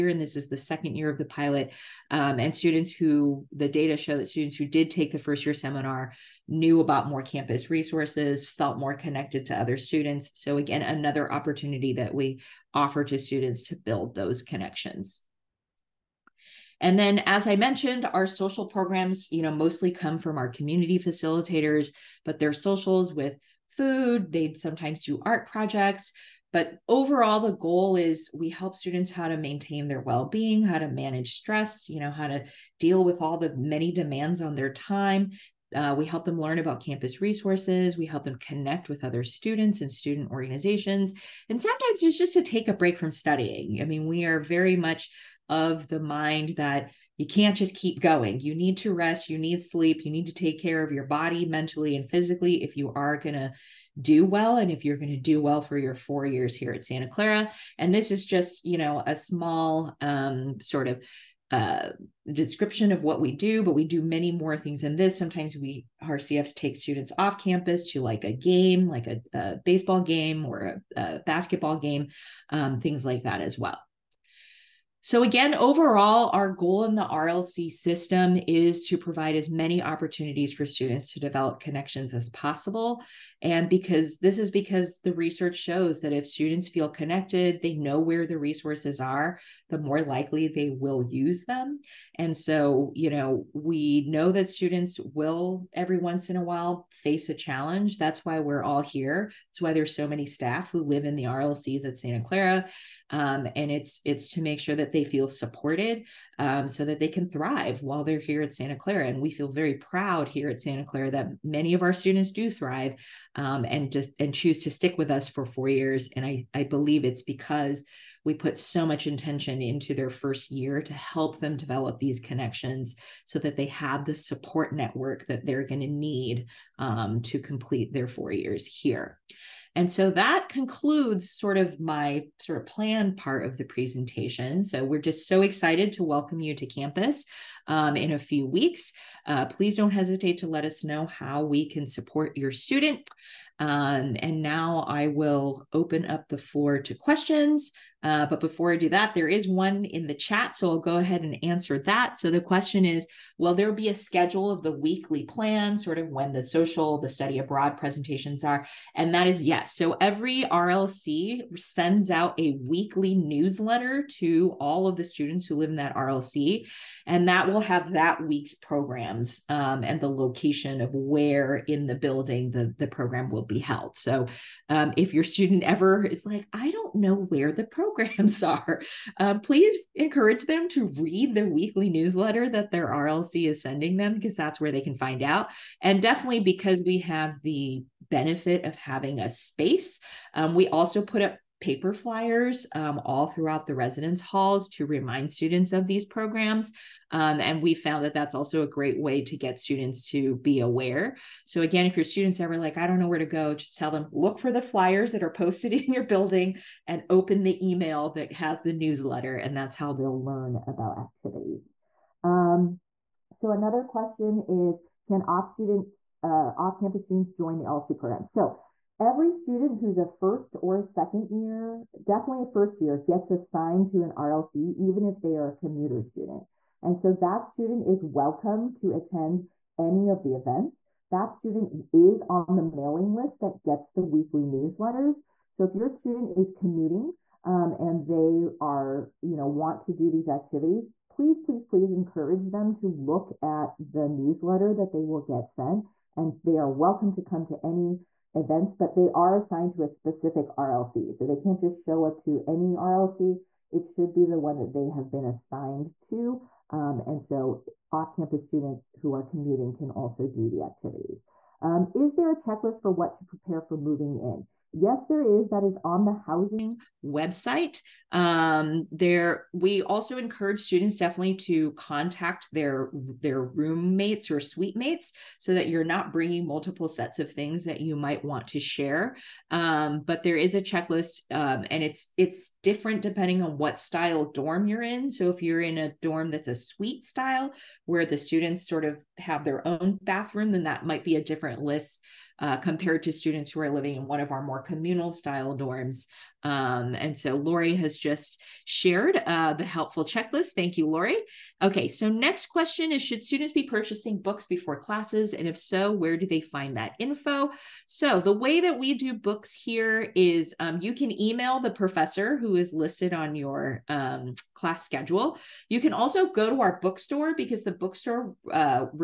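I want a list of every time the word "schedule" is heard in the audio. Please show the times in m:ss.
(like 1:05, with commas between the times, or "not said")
2:33, 5:14.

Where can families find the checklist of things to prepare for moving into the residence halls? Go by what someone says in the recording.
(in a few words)
housing website.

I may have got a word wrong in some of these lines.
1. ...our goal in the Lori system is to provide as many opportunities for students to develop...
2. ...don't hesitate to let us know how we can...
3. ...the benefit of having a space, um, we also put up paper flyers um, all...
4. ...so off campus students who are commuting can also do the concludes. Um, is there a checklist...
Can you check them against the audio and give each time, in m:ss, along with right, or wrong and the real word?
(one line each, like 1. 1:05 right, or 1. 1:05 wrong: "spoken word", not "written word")
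1. 1:16 wrong: "RLC", not "Lori"
2. 2:19 right
3. 3:07 right
4. 4:17 wrong: "activities", not "concludes".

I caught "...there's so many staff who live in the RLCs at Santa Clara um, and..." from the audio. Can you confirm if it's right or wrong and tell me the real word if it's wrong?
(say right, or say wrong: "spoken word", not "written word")
right.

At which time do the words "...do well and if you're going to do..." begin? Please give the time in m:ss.
0:54.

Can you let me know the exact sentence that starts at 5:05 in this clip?
And if so, where do they find that info?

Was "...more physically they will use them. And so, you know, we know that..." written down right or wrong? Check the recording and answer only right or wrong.
wrong.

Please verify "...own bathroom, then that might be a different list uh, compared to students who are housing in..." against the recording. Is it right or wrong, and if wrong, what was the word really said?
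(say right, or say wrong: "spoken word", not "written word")
wrong: "living", not "housing".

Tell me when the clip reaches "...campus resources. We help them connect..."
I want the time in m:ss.
0:36.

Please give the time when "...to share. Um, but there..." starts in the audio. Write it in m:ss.
4:38.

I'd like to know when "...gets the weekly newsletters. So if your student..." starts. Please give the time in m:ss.
3:53.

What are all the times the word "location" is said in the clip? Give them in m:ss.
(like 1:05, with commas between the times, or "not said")
2:50.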